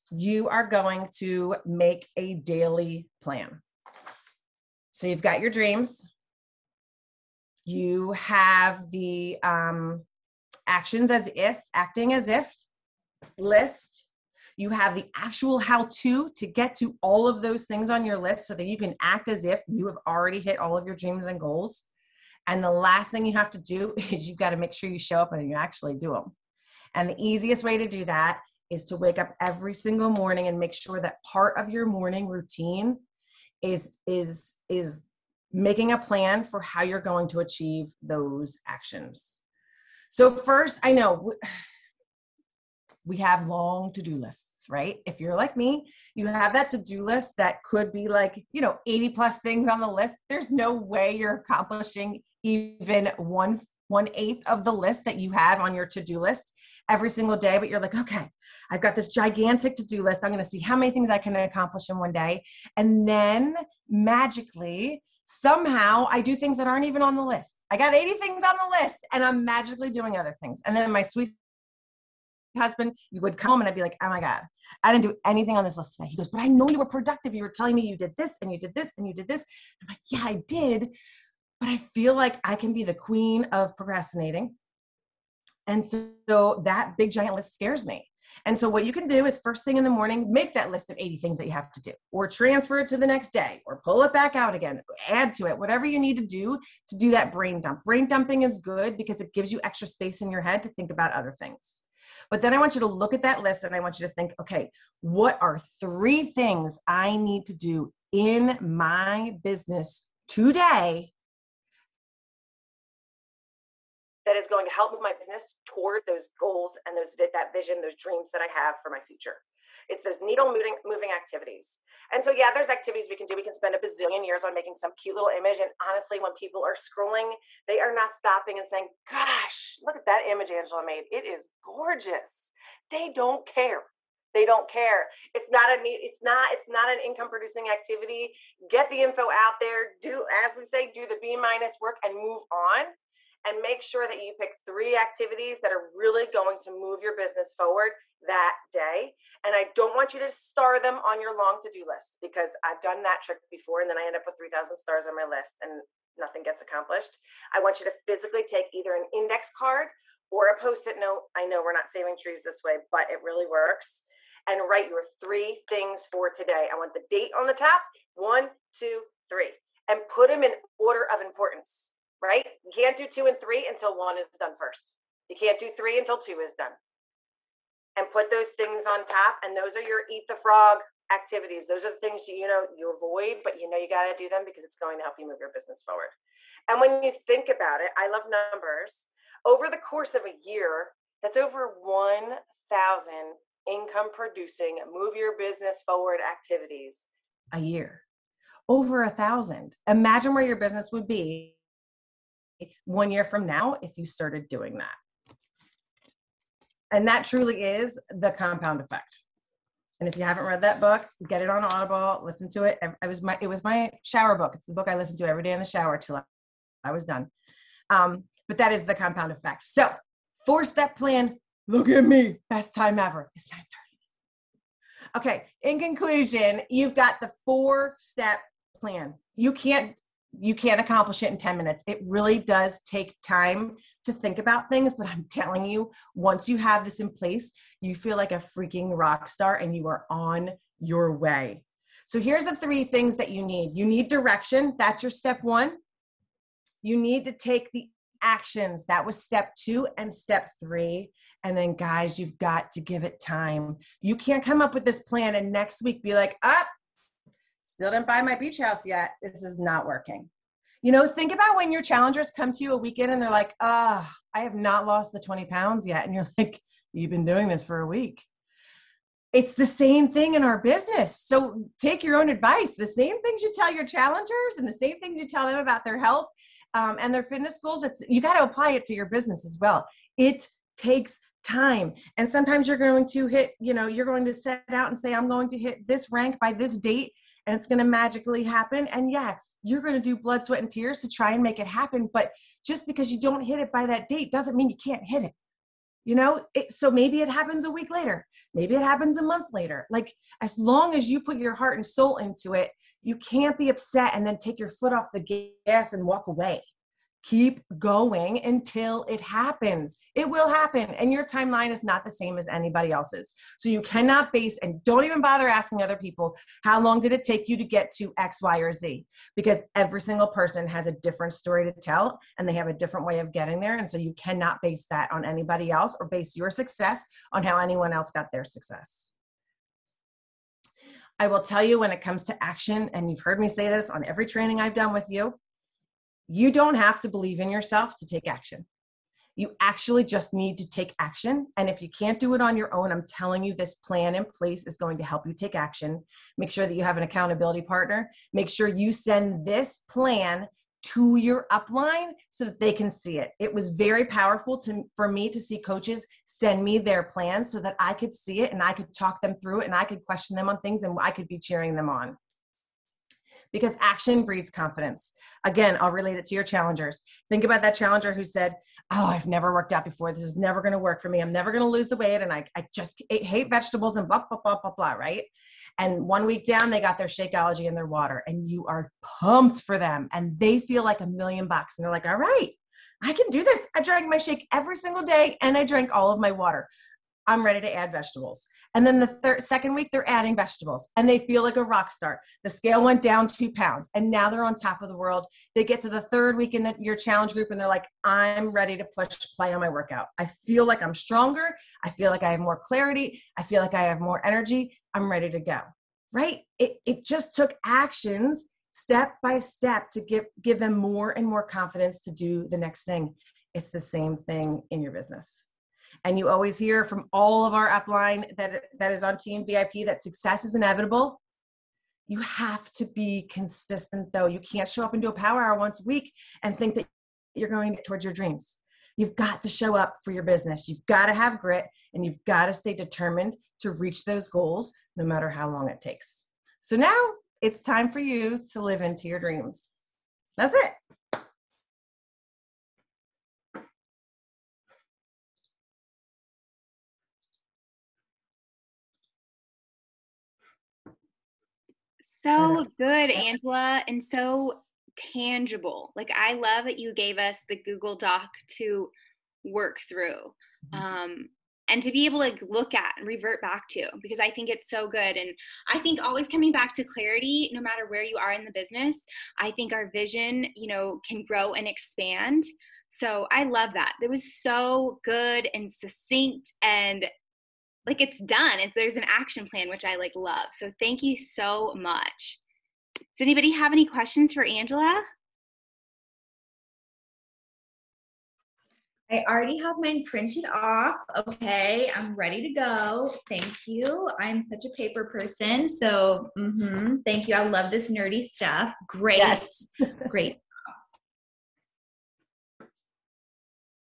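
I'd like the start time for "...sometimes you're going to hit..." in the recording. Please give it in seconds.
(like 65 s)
282 s.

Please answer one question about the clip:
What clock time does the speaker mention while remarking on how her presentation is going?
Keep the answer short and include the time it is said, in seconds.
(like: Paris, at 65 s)
9:30, at 223 s.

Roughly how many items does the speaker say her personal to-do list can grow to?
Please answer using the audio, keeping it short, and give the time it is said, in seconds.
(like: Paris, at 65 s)
80, at 48 s.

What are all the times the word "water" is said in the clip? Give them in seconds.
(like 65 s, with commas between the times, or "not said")
377 s, 386 s.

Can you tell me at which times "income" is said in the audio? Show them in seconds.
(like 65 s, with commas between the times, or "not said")
136 s, 193 s.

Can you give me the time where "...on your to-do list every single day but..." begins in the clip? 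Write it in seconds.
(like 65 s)
55 s.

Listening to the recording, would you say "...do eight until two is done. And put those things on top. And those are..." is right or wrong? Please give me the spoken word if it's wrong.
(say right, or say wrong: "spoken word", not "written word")
wrong: "three", not "eight".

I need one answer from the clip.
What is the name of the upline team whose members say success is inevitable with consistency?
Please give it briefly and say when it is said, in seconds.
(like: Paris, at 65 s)
Team VIP, at 419 s.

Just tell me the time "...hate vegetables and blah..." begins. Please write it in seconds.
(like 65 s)
373 s.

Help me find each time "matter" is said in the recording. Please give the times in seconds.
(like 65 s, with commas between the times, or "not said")
435 s, 467 s.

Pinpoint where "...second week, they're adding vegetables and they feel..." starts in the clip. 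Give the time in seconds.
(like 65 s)
389 s.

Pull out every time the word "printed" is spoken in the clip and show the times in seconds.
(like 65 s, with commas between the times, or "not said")
490 s.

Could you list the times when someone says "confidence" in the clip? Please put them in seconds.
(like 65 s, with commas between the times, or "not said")
364 s, 411 s.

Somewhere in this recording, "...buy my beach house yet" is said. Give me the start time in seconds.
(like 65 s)
258 s.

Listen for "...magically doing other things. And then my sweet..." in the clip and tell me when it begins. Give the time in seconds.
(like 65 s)
69 s.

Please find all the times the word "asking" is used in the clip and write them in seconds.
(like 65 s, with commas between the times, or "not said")
315 s.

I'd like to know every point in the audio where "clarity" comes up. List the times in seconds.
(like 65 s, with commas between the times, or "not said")
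402 s, 466 s.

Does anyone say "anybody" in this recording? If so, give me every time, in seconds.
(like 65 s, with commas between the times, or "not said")
312 s, 325 s, 483 s.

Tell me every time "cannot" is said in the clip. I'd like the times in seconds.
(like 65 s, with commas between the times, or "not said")
313 s, 324 s.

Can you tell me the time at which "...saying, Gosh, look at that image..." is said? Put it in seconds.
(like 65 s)
128 s.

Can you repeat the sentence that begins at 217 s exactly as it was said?
Um, but that is the compound effect.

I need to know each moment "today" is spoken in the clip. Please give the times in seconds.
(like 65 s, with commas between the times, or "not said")
75 s, 110 s, 166 s.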